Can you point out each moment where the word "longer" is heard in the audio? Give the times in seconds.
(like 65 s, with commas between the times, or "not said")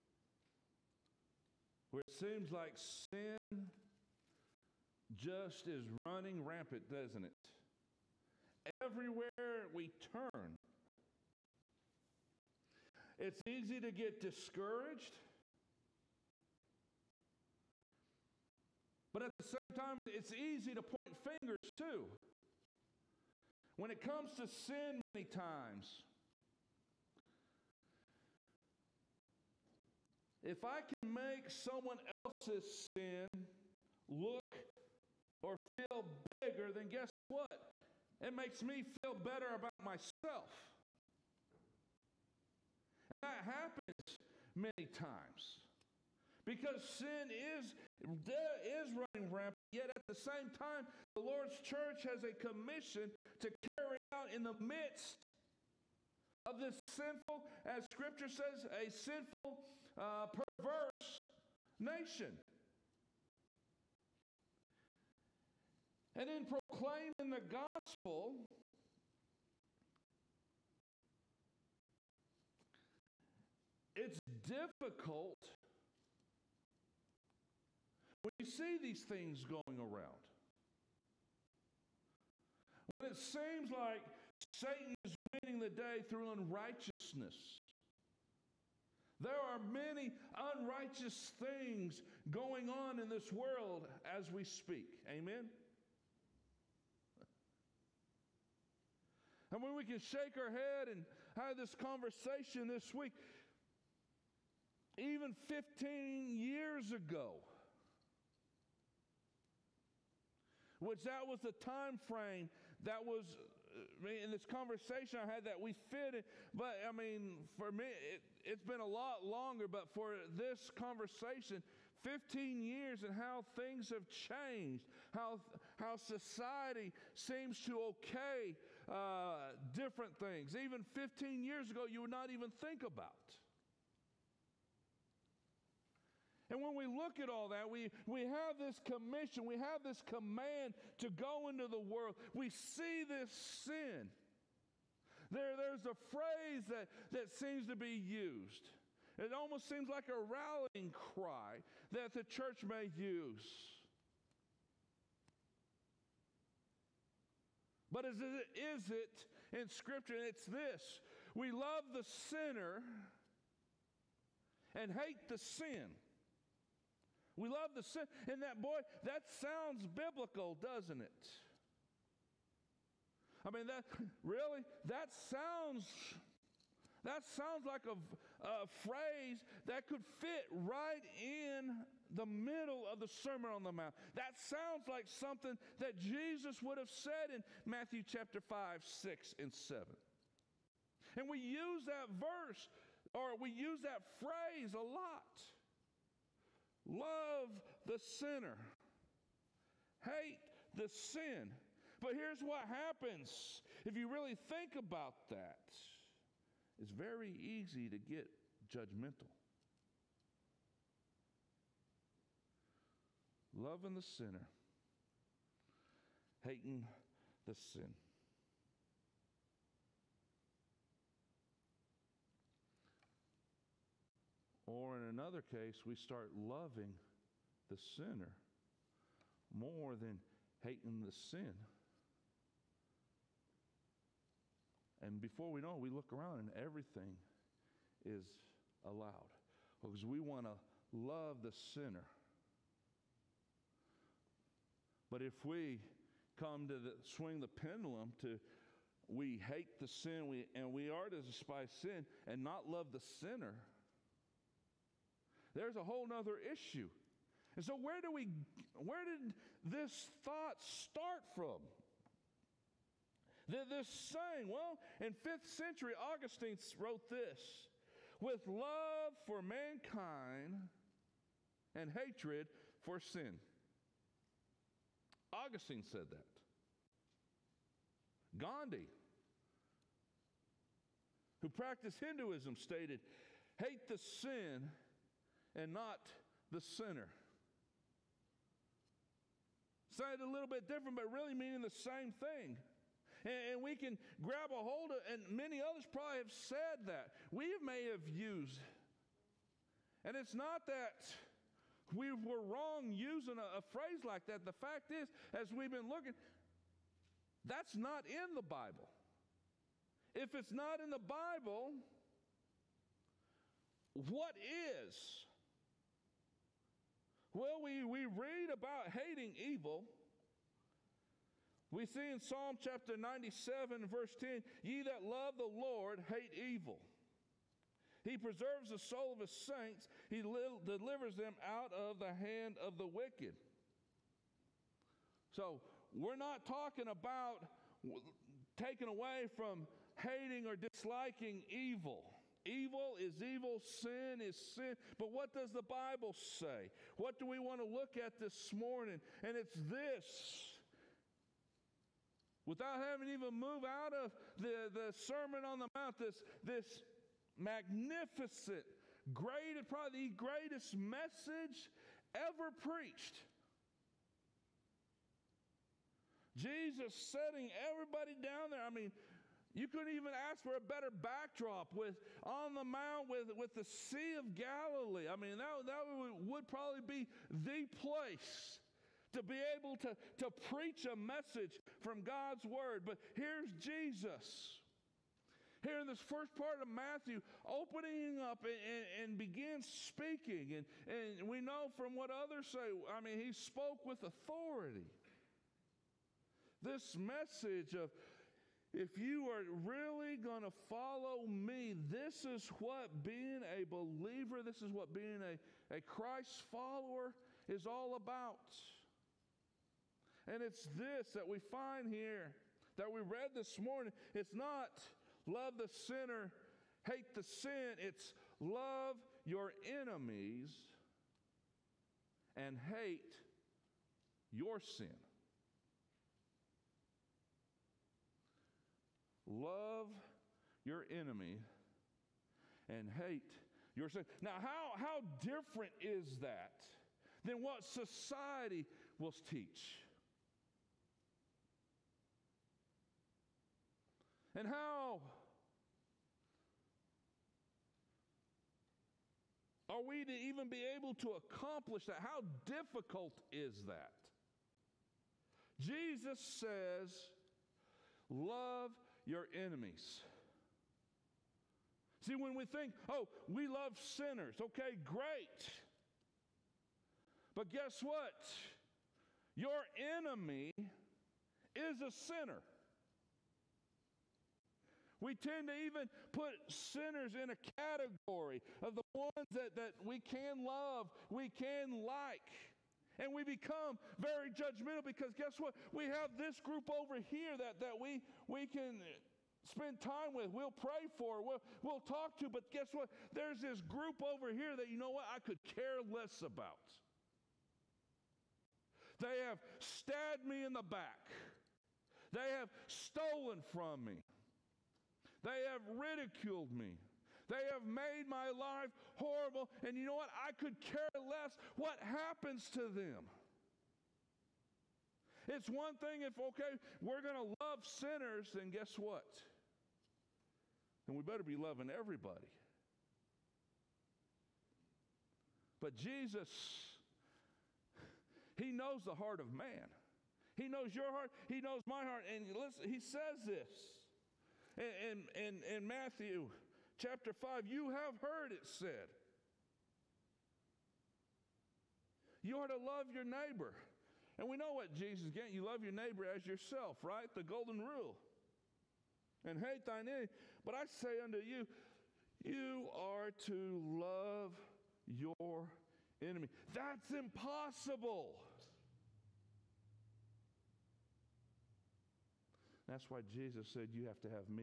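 119 s.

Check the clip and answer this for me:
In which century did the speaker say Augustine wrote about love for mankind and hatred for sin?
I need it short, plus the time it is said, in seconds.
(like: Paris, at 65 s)
5th century, at 265 s.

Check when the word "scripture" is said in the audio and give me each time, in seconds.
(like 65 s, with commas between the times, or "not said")
57 s, 159 s.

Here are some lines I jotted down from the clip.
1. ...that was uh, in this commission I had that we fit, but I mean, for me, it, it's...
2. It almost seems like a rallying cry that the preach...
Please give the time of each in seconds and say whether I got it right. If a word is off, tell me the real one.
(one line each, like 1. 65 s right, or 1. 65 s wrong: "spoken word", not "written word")
1. 112 s wrong: "conversation", not "commission"
2. 149 s wrong: "church", not "preach".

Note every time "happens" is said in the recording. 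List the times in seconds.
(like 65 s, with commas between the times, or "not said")
43 s, 202 s, 511 s.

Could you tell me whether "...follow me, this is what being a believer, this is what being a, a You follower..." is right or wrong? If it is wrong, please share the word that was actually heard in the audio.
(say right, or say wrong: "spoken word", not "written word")
wrong: "Christ", not "You".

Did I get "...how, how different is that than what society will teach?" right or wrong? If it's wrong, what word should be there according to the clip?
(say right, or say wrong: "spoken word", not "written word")
right.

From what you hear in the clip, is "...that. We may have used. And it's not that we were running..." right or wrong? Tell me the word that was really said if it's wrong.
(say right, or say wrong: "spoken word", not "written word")
wrong: "wrong", not "running".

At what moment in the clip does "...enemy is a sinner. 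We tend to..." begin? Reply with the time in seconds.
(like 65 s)
469 s.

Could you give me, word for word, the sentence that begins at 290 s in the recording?
it a little bit different, but really meaning the same thing.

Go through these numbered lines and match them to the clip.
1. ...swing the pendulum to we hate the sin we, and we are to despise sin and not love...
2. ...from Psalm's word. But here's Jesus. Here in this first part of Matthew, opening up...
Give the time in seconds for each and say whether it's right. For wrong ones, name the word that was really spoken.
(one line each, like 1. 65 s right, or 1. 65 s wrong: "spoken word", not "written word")
1. 247 s right
2. 381 s wrong: "God", not "Psalm".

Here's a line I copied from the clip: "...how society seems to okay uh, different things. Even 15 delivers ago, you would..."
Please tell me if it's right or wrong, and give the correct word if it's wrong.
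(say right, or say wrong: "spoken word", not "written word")
wrong: "years", not "delivers".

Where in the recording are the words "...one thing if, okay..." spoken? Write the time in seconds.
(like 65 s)
515 s.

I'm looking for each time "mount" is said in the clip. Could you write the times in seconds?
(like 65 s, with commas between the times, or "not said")
183 s, 355 s, 372 s.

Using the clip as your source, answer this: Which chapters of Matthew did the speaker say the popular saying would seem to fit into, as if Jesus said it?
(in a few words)
5, 6, and 7.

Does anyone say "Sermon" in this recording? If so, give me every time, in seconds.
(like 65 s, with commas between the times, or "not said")
183 s, 355 s.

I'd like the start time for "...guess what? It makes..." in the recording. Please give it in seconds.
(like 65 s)
36 s.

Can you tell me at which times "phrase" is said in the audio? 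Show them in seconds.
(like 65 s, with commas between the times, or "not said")
146 s, 178 s, 194 s, 303 s.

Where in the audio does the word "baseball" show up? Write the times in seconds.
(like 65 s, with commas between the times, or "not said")
not said.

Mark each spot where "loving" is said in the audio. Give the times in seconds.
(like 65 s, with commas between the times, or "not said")
213 s, 226 s, 521 s.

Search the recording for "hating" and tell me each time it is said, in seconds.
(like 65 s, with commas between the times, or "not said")
216 s, 230 s, 318 s, 339 s.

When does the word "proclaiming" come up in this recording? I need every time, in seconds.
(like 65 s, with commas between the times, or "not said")
66 s.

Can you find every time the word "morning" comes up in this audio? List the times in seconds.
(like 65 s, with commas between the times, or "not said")
348 s, 413 s.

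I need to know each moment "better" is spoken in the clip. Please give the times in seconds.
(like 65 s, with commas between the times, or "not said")
39 s, 370 s, 521 s.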